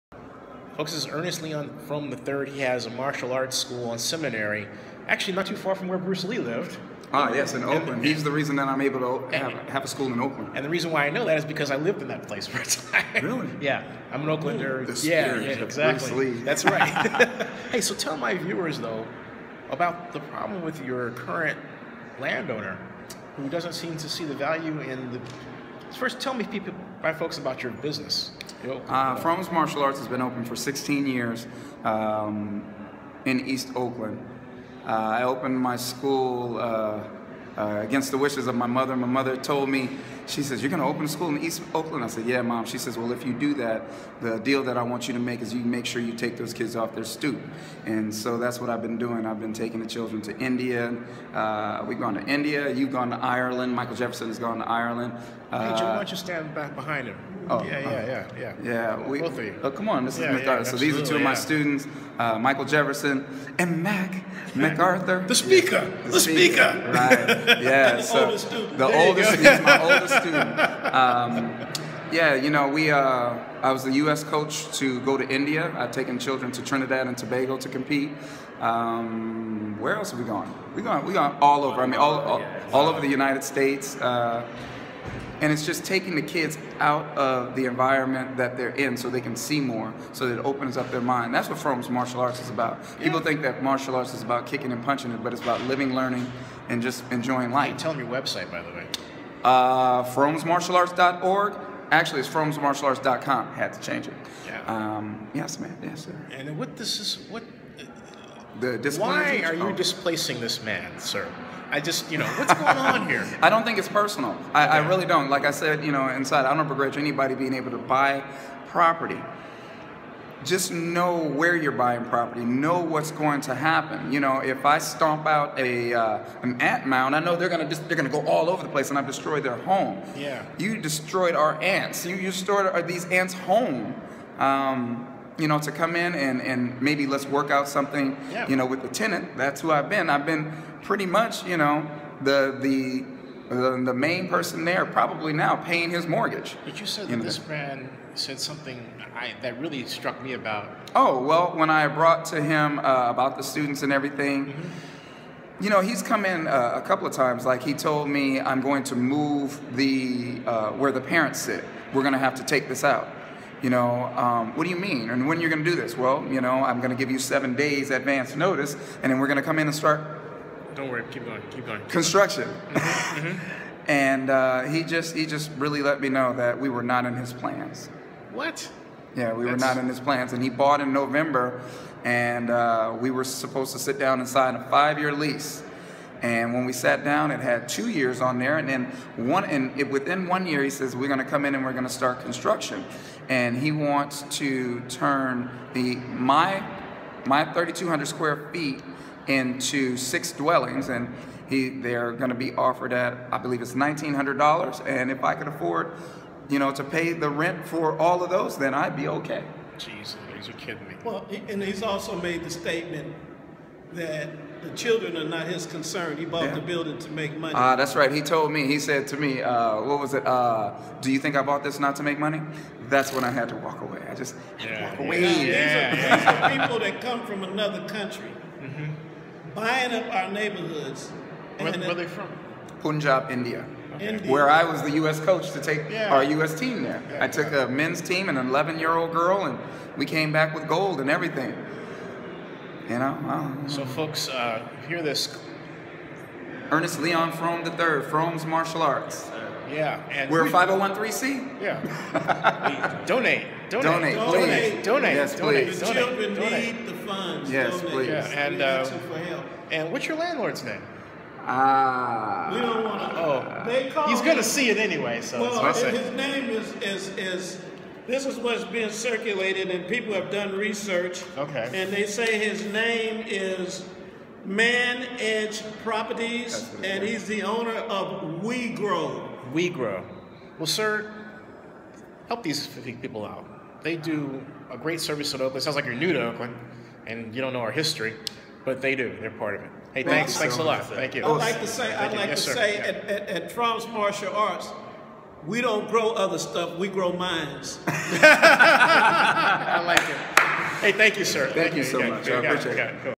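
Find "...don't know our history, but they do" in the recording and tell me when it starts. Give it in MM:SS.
04:47.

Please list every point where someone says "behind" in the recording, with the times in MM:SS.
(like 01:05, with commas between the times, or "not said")
00:56.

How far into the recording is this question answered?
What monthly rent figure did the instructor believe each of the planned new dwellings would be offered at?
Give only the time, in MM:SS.
03:23.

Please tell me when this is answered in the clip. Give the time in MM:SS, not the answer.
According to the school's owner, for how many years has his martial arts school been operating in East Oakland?
00:30.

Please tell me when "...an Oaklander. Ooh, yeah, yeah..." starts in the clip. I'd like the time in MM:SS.
00:14.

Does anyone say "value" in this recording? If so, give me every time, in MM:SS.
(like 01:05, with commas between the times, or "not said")
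00:24.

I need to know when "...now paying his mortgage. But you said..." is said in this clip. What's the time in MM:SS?
02:25.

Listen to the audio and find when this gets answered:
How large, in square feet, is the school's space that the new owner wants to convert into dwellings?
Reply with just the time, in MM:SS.
03:17.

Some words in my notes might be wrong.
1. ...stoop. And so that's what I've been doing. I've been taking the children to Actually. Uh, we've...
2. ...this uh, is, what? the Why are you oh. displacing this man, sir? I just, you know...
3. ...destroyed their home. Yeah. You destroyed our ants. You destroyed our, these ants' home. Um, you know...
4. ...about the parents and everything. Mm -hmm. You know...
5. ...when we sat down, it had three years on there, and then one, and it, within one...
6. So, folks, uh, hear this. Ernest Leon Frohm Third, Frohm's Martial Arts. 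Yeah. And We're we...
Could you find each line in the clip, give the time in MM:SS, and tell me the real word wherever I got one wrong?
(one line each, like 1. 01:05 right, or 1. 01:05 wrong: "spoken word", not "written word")
1. 00:47 wrong: "India", not "Actually"
2. 01:46 right
3. 02:09 right
4. 02:33 wrong: "students", not "parents"
5. 03:06 wrong: "two", not "three"
6. 04:03 right.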